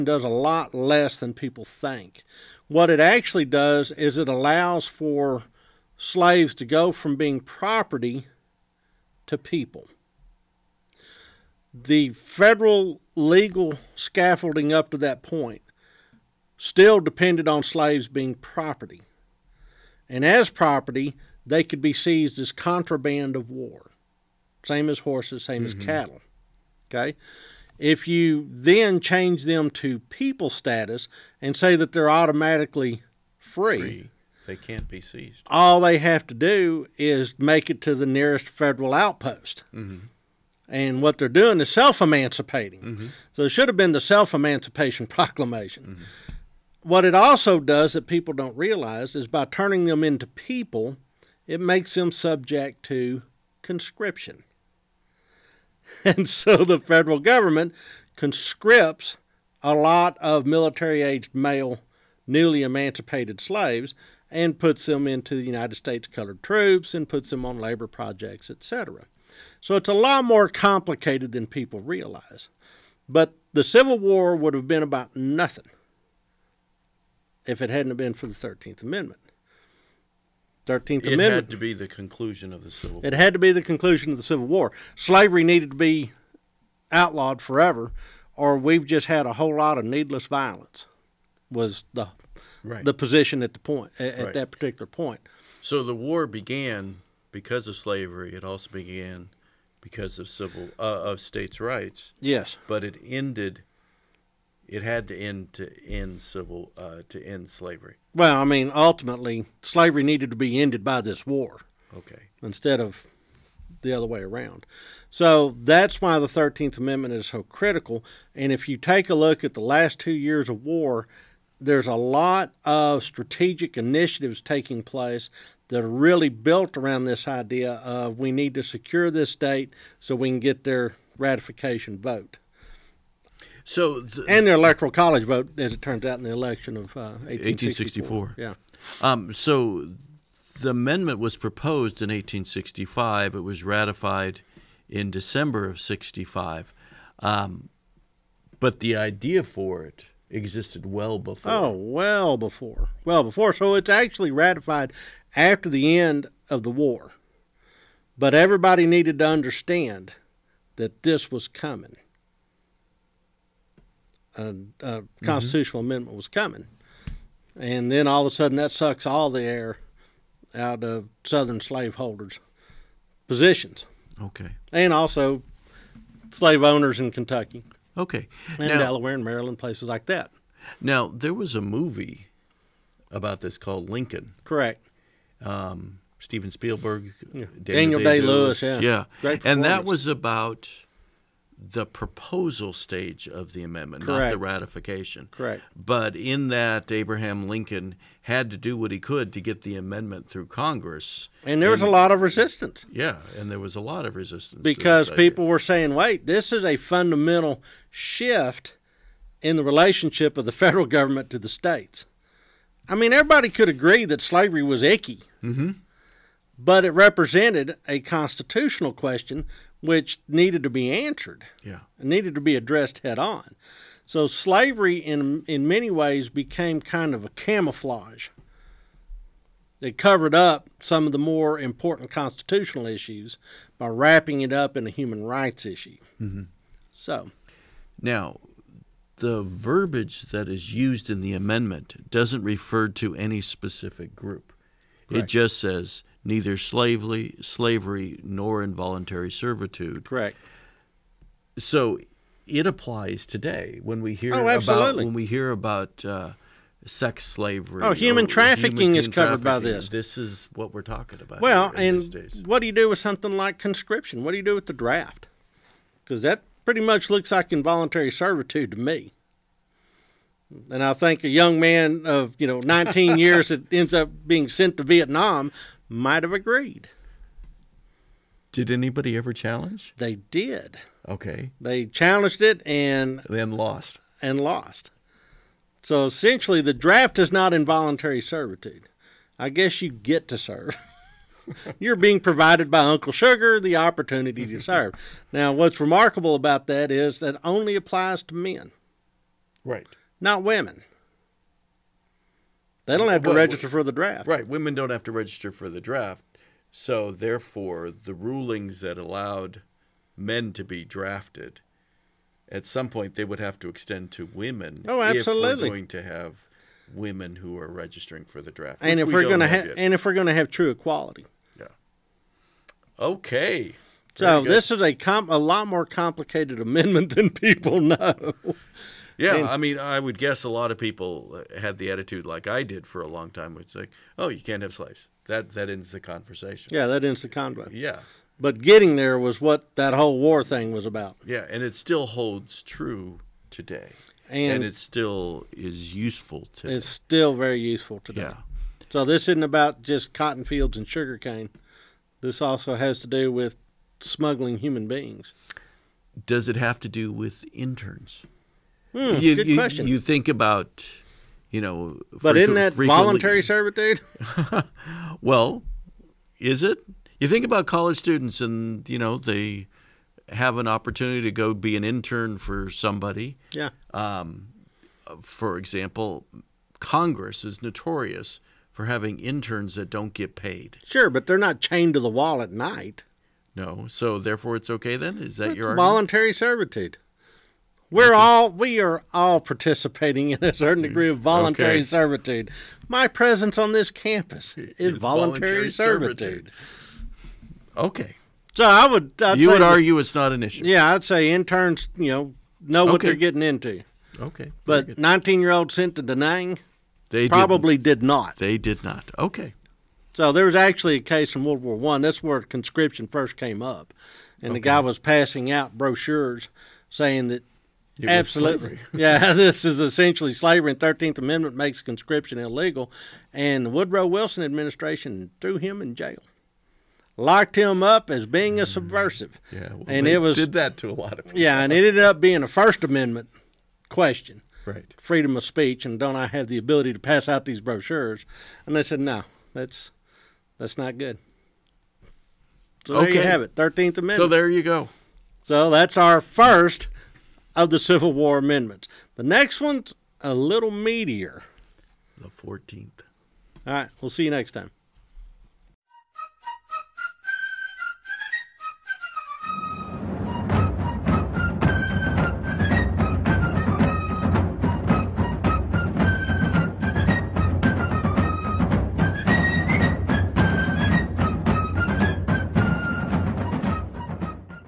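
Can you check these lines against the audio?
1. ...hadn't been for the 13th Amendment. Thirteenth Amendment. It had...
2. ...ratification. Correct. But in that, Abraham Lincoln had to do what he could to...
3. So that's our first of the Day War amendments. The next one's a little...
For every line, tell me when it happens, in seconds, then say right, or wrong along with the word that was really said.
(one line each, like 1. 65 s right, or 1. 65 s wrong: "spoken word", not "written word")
1. 77 s right
2. 194 s right
3. 445 s wrong: "Civil", not "Day".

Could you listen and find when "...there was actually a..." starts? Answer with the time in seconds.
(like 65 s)
410 s.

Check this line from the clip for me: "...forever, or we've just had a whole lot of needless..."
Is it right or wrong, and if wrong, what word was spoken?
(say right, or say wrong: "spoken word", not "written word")
right.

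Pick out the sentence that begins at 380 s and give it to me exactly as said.
Sure, but they're not chained to the wall at night.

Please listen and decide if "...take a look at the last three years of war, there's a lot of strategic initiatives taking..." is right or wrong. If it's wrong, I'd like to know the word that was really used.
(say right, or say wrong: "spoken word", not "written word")
wrong: "two", not "three".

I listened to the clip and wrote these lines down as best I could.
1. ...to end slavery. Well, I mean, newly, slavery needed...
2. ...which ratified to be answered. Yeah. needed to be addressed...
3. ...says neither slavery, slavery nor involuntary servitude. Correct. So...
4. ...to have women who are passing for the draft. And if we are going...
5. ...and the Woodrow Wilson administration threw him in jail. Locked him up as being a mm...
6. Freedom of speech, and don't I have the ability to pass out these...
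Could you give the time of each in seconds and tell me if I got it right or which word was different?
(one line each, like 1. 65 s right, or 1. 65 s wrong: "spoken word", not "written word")
1. 107 s wrong: "ultimately", not "newly"
2. 219 s wrong: "needed", not "ratified"
3. 245 s right
4. 315 s wrong: "registering", not "passing"
5. 423 s right
6. 434 s right.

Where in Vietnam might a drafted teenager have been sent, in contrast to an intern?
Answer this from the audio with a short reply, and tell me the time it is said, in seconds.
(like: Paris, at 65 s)
Da Nang, at 406 s.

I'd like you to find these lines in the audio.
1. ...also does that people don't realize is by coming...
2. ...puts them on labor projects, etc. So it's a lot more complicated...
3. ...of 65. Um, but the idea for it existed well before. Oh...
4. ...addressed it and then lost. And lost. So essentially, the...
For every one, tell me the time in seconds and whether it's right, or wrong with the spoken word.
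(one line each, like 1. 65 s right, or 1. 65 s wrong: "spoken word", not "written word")
1. 47 s wrong: "turning", not "coming"
2. 67 s right
3. 145 s right
4. 281 s wrong: "challenged", not "addressed".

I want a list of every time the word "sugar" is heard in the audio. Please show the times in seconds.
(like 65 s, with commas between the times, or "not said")
293 s, 350 s.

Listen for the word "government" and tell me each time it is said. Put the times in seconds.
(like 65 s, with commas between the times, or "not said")
57 s, 210 s.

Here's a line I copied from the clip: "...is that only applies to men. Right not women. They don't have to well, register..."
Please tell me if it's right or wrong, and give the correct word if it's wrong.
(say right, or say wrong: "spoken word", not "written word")
right.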